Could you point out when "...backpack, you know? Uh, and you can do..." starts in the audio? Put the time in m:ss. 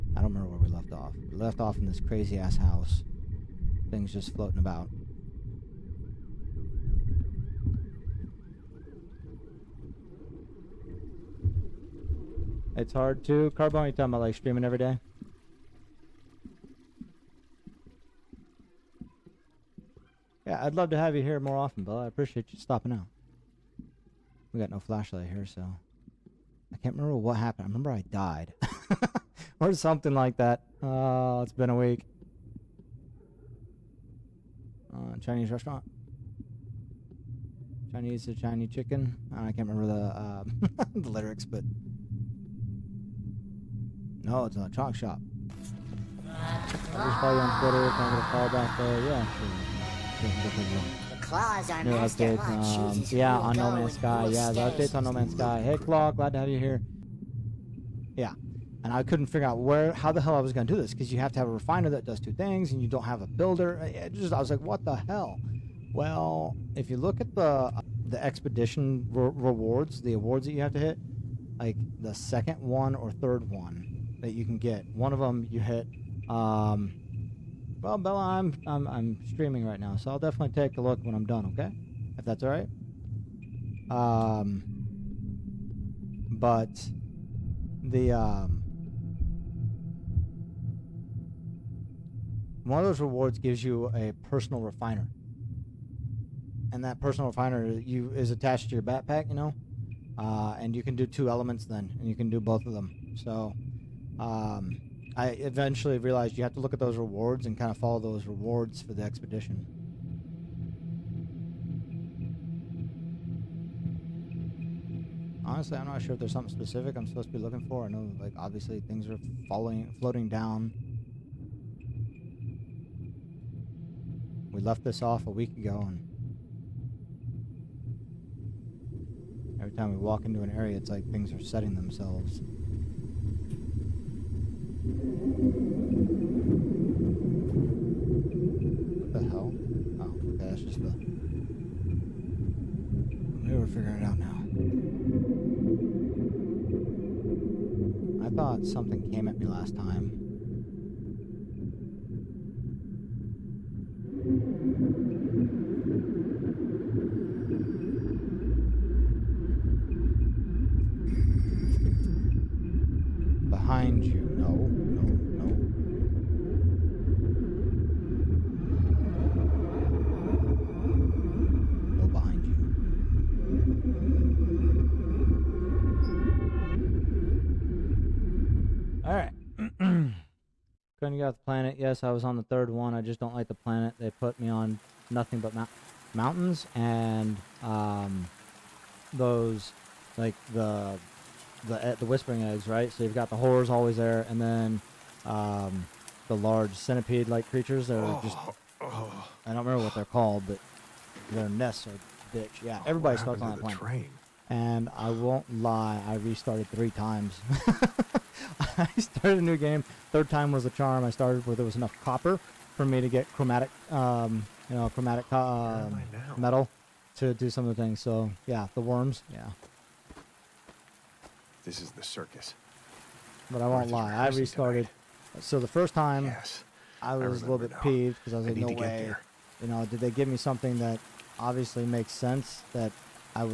1:38.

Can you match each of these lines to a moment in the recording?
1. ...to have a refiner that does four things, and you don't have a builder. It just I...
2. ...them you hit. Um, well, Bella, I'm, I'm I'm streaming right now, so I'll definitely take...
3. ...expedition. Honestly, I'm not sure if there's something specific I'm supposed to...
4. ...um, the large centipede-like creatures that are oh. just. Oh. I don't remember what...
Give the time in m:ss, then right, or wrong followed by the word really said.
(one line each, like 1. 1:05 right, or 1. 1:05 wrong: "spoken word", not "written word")
1. 1:01 wrong: "two", not "four"
2. 1:15 right
3. 1:49 right
4. 3:15 right.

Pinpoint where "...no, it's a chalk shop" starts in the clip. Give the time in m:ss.
0:44.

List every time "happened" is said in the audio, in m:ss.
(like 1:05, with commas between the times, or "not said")
0:27.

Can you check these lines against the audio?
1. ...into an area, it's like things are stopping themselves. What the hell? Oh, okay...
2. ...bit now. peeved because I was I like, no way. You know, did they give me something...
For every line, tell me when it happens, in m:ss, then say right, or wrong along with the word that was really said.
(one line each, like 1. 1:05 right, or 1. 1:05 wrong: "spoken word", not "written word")
1. 2:10 wrong: "setting", not "stopping"
2. 3:47 right.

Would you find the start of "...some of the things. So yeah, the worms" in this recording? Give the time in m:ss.
3:37.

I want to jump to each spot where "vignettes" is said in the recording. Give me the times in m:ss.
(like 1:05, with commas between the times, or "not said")
not said.